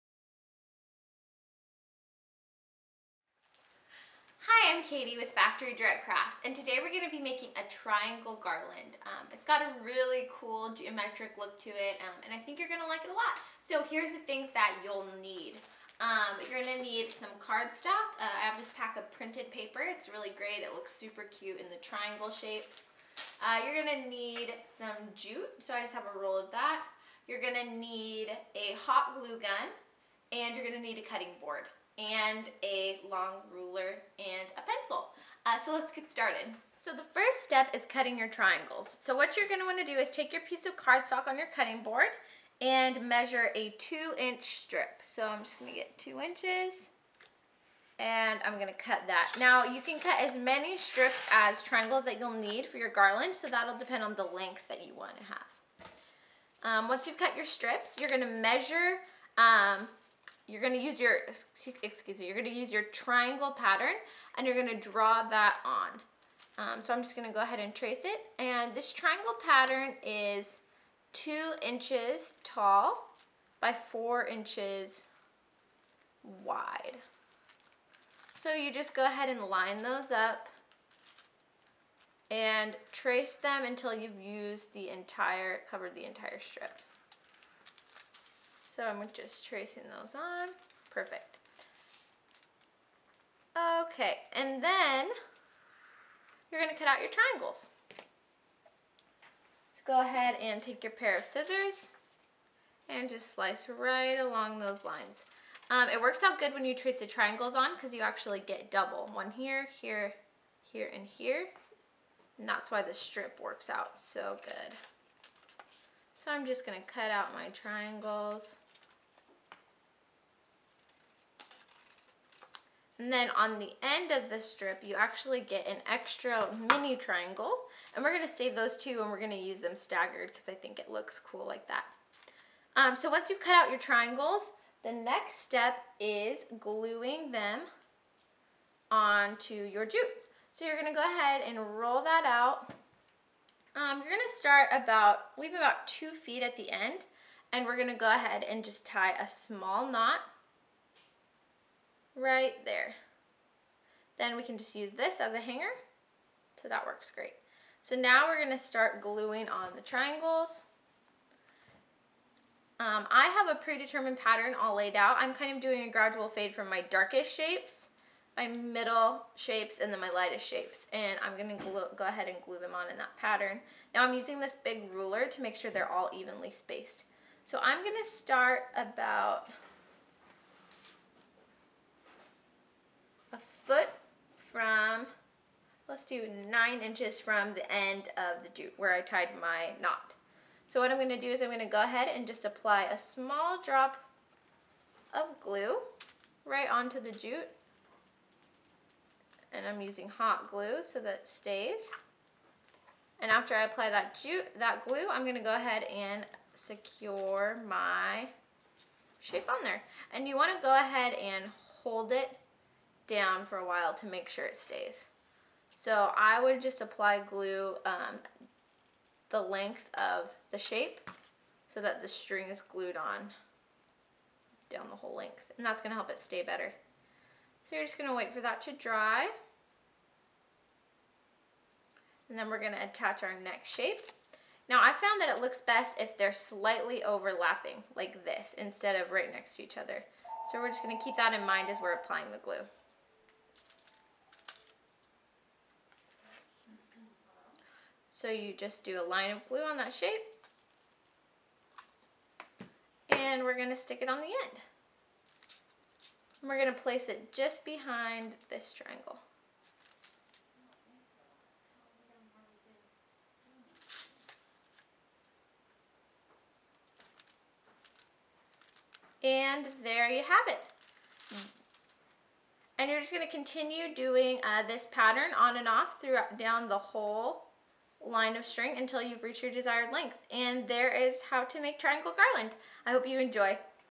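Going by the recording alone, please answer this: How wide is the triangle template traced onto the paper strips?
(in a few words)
4 inches.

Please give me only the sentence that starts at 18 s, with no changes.
Uh, I have this pack of printed paper.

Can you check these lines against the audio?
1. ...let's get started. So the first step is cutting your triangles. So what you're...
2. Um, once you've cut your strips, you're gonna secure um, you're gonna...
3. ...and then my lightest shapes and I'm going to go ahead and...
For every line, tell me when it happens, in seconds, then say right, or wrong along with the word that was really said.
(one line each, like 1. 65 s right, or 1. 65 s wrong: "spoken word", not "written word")
1. 35 s right
2. 56 s wrong: "measure", not "secure"
3. 169 s right.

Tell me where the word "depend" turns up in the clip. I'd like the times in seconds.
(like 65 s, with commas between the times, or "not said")
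53 s.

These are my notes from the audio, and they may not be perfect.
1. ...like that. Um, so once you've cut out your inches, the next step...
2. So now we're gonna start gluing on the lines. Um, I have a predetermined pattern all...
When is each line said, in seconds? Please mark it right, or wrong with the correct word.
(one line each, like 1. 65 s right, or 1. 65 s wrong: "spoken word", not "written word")
1. 131 s wrong: "triangles", not "inches"
2. 157 s wrong: "triangles", not "lines".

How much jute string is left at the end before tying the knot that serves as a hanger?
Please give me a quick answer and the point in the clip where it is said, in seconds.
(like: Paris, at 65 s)
2 feet, at 145 s.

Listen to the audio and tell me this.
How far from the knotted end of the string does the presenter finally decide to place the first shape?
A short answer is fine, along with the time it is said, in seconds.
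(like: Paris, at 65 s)
9 inches, at 186 s.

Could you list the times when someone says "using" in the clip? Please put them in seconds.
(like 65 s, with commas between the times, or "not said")
174 s, 199 s.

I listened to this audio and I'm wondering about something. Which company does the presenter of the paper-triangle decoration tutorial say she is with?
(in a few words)
Factory Direct Crafts.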